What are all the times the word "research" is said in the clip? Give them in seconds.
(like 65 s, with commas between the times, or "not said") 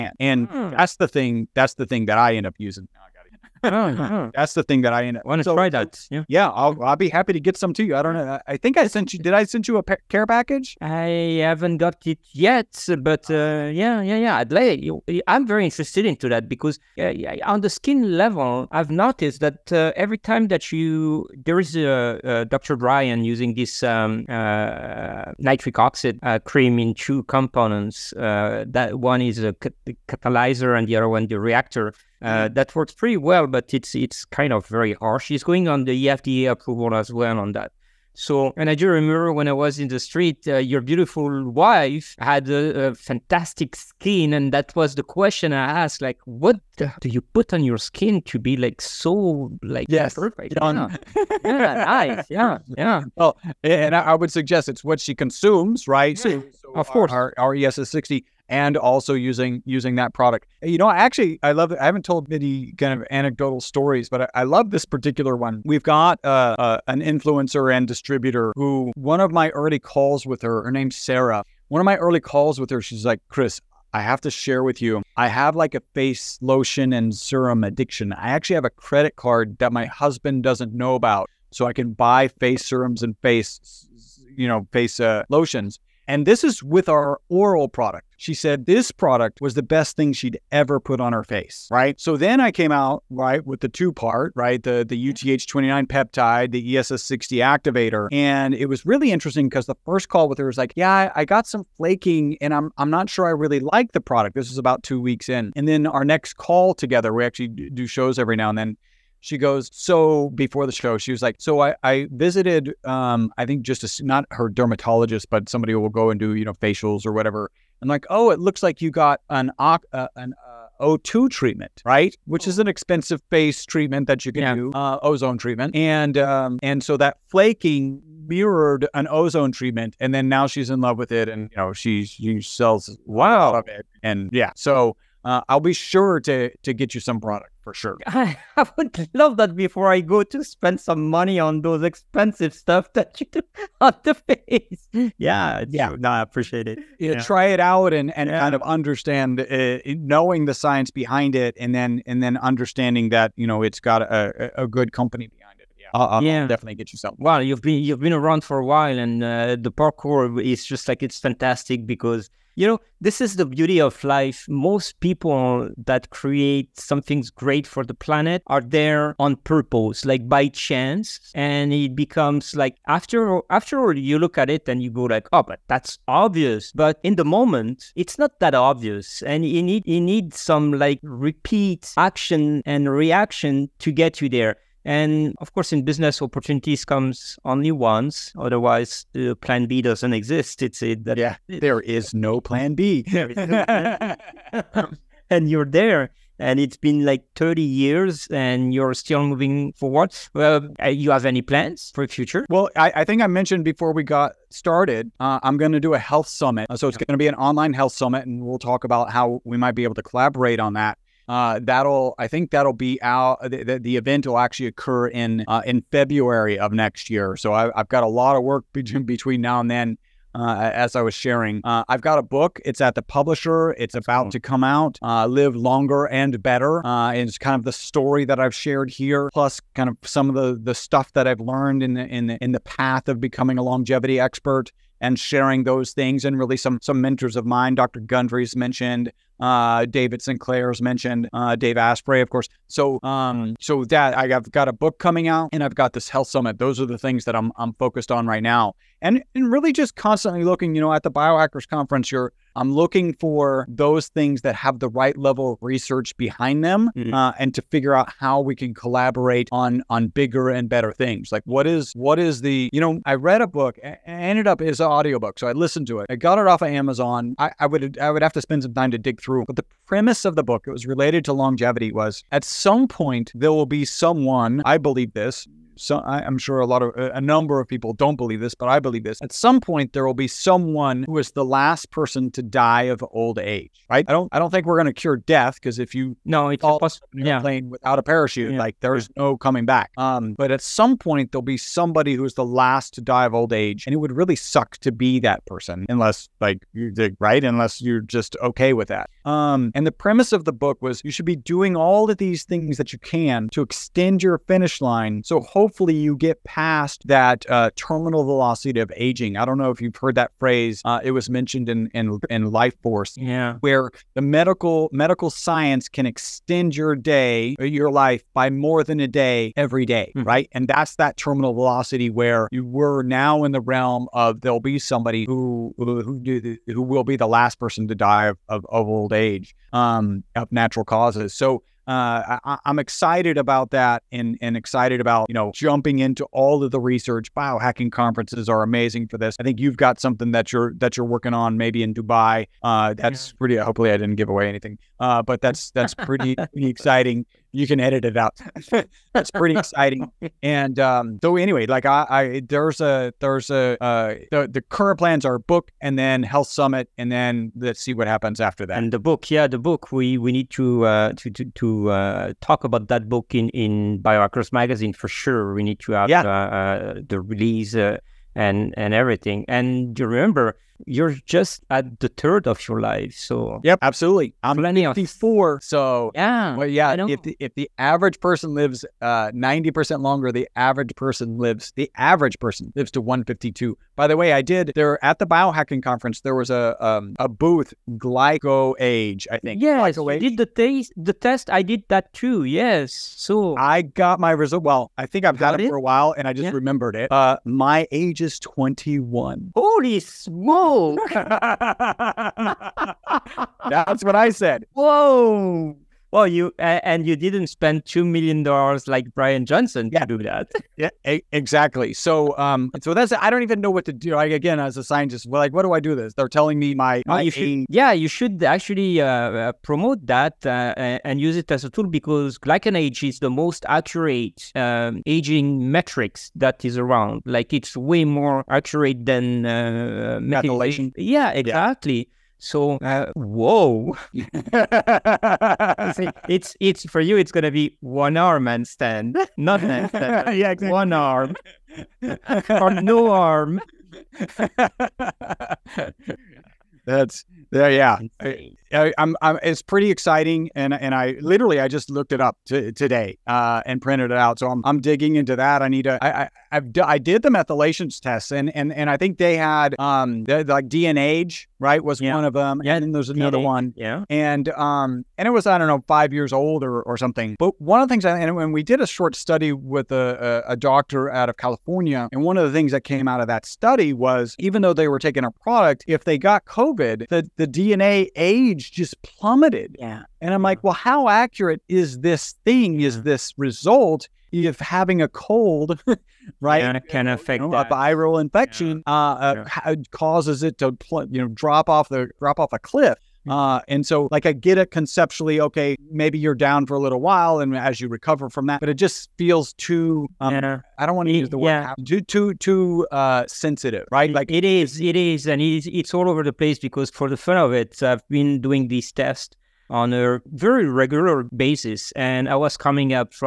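255 s, 336 s.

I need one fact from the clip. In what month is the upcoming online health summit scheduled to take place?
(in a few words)
February.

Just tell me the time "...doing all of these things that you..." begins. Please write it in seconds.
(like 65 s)
301 s.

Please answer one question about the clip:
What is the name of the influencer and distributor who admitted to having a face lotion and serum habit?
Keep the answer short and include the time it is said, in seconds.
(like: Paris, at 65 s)
Sarah, at 70 s.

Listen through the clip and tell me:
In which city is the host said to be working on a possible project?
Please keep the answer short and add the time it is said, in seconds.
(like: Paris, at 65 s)
Dubai, at 341 s.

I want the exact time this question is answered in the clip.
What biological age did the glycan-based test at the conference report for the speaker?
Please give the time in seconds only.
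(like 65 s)
398 s.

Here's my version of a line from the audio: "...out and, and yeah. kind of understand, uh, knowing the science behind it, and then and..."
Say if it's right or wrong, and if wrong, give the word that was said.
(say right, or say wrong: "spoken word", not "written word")
right.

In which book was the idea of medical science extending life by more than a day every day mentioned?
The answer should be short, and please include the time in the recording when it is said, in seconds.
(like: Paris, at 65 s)
Life Force, at 312 s.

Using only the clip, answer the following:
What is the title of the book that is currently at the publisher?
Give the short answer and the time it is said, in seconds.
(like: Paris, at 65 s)
Live Longer and Better, at 225 s.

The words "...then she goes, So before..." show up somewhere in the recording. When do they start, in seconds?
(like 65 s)
108 s.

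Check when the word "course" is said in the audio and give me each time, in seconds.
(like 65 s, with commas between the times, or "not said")
56 s, 185 s, 242 s.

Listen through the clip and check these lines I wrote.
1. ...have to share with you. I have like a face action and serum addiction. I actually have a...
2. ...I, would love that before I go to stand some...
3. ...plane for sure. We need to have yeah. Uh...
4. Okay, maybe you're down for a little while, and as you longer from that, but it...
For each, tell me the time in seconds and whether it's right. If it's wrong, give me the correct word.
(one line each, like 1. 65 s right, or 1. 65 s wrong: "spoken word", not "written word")
1. 73 s wrong: "lotion", not "action"
2. 138 s wrong: "spend", not "stand"
3. 364 s wrong: "magazine", not "plane"
4. 495 s wrong: "recover", not "longer".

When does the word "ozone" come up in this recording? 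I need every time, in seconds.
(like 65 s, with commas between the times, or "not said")
125 s, 129 s.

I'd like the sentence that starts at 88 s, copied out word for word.
She said this product was the best thing she'd ever put on her face, right?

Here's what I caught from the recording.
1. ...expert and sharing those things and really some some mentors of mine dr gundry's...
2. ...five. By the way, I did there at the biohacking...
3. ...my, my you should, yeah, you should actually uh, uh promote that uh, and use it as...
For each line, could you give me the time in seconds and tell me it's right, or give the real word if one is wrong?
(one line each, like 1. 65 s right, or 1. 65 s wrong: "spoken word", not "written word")
1. 234 s right
2. 383 s wrong: "two", not "five"
3. 416 s right.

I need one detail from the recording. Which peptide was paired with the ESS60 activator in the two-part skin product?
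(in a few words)
UTH29.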